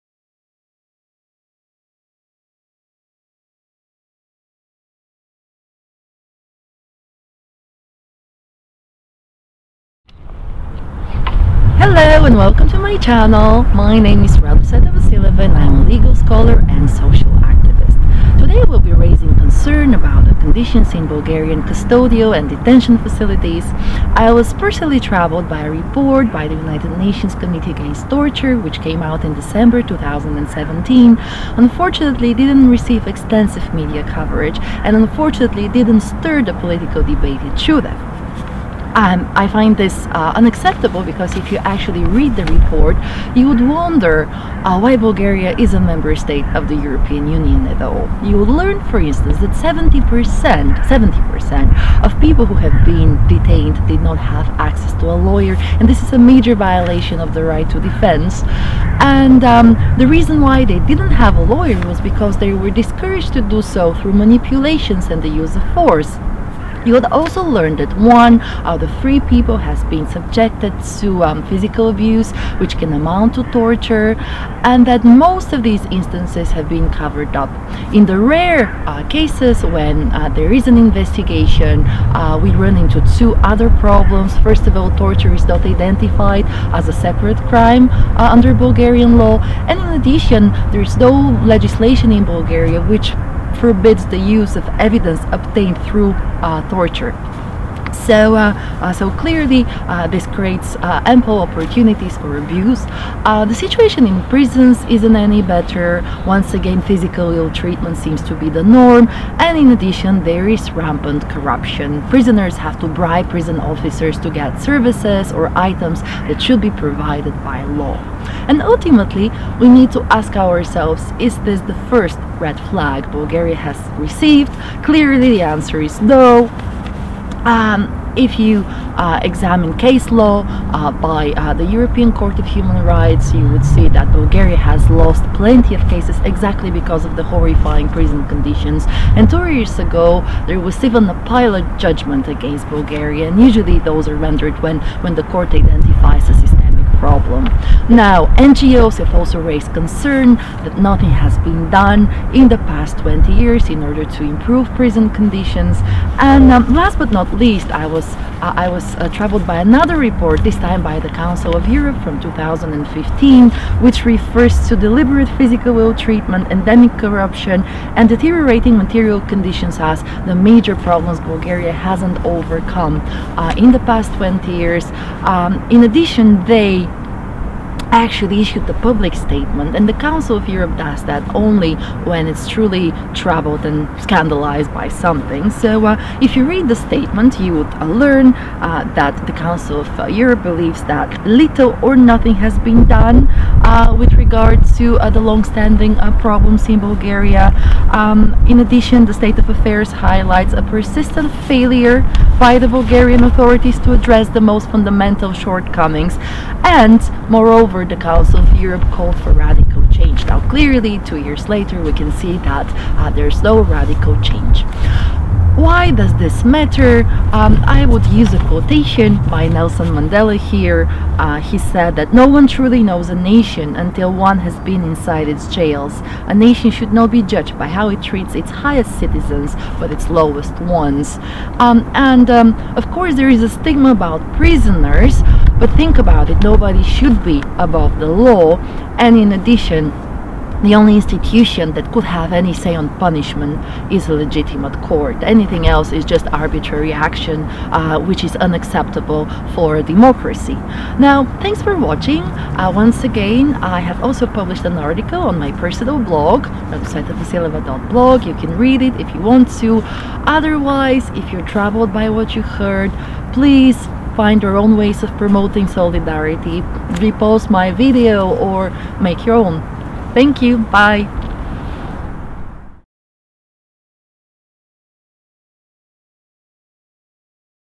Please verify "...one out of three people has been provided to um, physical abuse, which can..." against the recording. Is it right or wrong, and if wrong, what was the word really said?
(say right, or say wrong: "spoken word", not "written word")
wrong: "subjected", not "provided".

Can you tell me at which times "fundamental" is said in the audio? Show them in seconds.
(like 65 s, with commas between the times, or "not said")
204 s.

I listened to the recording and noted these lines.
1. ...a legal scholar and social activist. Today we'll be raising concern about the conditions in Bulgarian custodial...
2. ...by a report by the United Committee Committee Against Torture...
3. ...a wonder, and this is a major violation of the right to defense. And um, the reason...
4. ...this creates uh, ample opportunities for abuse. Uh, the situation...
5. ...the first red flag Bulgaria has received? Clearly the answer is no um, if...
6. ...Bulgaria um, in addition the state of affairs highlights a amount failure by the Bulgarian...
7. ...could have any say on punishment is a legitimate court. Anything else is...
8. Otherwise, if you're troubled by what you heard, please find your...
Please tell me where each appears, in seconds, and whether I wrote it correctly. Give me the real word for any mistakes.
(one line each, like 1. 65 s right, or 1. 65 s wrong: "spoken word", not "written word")
1. 15 s right
2. 25 s wrong: "Nations", not "Committee"
3. 55 s wrong: "lawyer", not "wonder"
4. 100 s right
5. 121 s right
6. 196 s wrong: "persistent", not "amount"
7. 241 s right
8. 260 s right.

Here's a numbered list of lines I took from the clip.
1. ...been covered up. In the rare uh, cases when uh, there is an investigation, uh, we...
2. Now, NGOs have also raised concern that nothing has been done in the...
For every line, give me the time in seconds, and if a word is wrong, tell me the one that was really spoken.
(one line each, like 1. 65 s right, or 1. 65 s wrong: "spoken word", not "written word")
1. 76 s right
2. 147 s right.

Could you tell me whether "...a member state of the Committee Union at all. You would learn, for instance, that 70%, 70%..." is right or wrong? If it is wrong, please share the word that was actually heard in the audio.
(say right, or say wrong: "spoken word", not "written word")
wrong: "European", not "Committee".